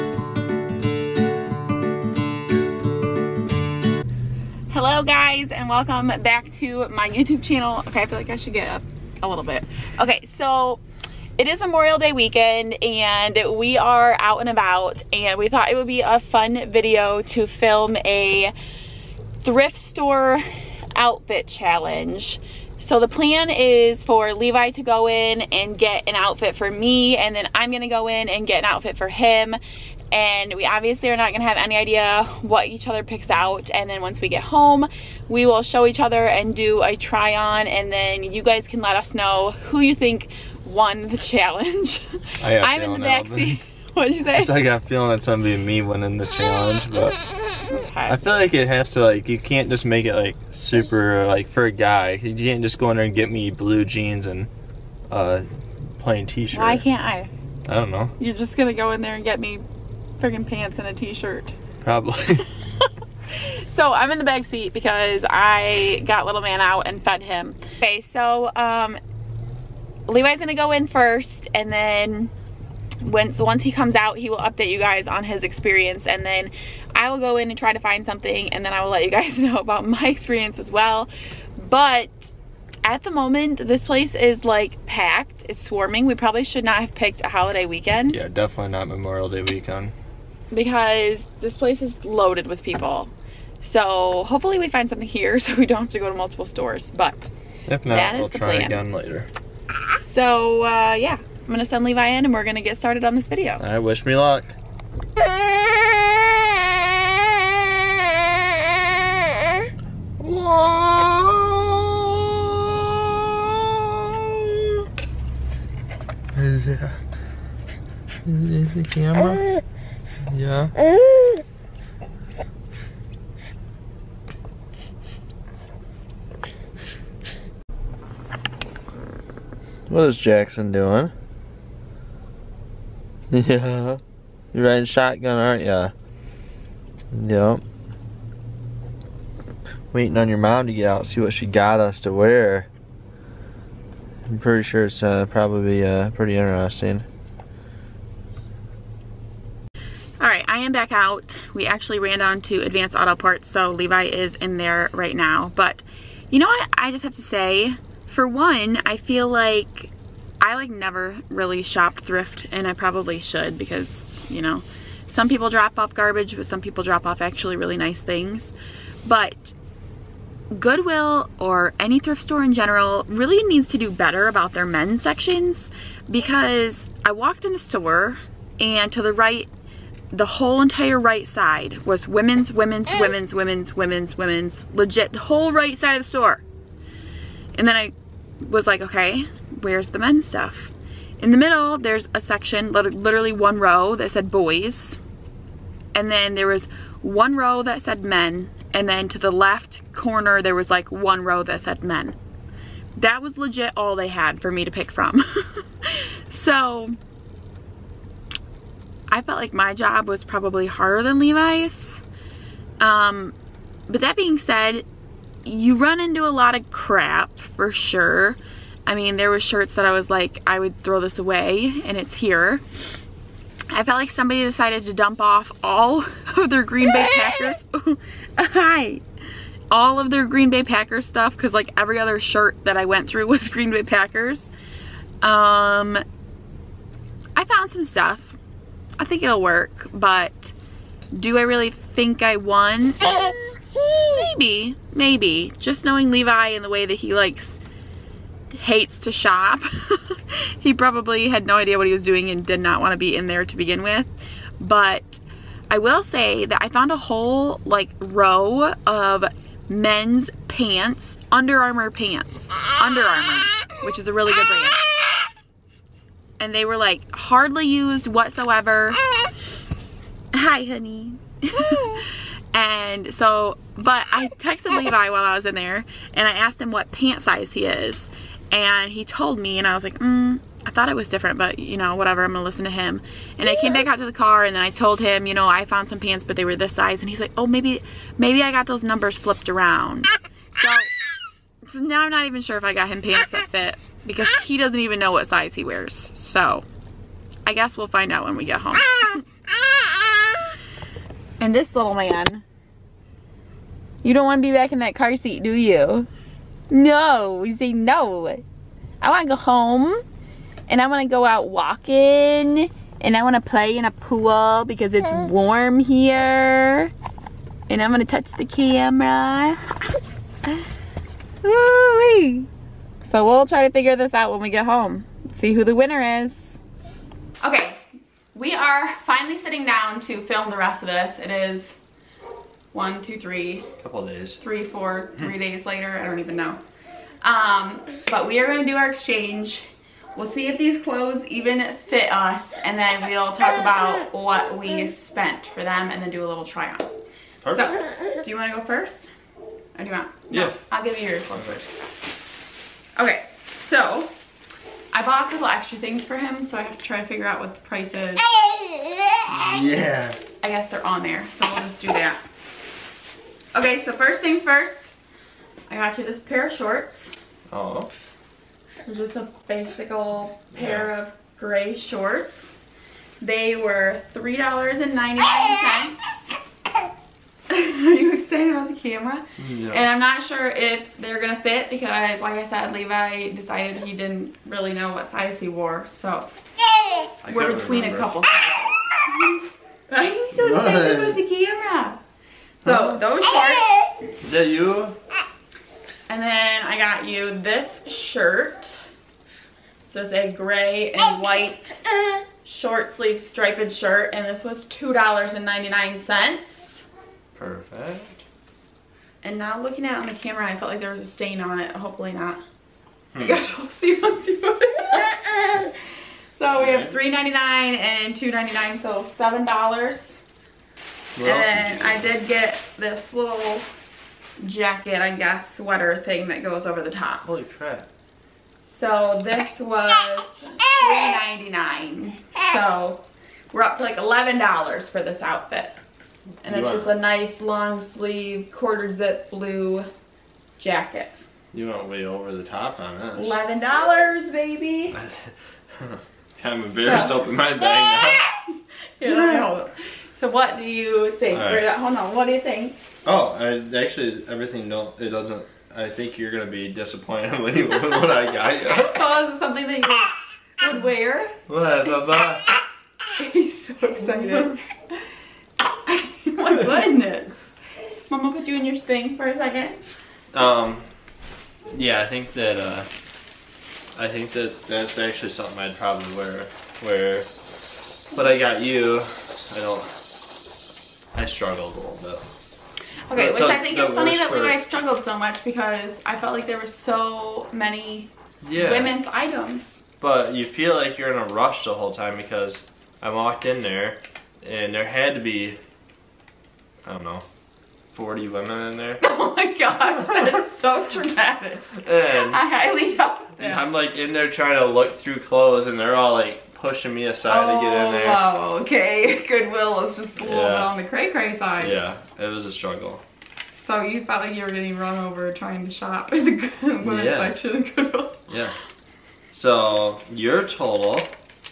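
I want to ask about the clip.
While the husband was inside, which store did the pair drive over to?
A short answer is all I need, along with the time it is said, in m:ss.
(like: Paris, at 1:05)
Advanced Auto Parts, at 2:32.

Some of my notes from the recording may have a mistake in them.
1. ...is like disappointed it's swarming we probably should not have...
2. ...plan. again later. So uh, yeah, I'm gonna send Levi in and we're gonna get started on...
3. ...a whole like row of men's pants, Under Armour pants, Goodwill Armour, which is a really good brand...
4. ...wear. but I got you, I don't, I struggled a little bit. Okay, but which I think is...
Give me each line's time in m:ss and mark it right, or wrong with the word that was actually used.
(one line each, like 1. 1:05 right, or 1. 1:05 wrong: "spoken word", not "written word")
1. 1:24 wrong: "packed", not "disappointed"
2. 1:38 right
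3. 4:16 wrong: "Under", not "Goodwill"
4. 7:56 right.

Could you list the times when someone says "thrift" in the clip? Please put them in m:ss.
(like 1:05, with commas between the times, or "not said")
0:19, 2:42, 2:51.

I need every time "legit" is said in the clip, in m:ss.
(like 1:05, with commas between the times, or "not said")
3:04, 3:23.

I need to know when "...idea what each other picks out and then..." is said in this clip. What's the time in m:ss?
0:31.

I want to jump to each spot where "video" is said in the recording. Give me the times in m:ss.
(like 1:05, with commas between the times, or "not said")
0:16, 1:43.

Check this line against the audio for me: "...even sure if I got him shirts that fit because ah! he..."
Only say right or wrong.
wrong.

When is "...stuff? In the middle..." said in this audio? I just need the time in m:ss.
3:10.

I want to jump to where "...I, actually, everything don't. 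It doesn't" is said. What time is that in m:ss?
7:33.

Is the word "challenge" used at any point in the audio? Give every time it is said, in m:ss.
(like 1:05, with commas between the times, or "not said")
0:21, 0:41, 0:46.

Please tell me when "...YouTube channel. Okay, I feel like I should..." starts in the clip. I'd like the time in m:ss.
0:07.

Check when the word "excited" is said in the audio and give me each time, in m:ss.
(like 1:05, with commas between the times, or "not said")
6:18, 6:30, 7:43.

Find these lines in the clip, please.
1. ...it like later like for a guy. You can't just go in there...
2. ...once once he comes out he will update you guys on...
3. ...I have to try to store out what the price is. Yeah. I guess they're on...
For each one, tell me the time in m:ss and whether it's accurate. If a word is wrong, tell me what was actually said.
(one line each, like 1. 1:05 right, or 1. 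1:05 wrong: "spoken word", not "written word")
1. 0:50 wrong: "super", not "later"
2. 1:12 right
3. 5:56 wrong: "figure", not "store".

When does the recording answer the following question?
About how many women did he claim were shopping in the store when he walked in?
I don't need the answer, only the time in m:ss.
8:17.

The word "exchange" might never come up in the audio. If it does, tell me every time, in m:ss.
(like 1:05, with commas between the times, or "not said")
5:38.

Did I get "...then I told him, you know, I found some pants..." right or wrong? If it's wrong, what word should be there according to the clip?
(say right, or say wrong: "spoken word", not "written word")
right.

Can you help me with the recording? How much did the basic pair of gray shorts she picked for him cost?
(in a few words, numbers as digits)
$3.99.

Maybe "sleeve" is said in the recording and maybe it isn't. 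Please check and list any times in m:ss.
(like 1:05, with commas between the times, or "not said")
6:42, 7:17.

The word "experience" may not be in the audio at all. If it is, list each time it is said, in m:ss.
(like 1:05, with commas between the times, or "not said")
1:15, 1:20.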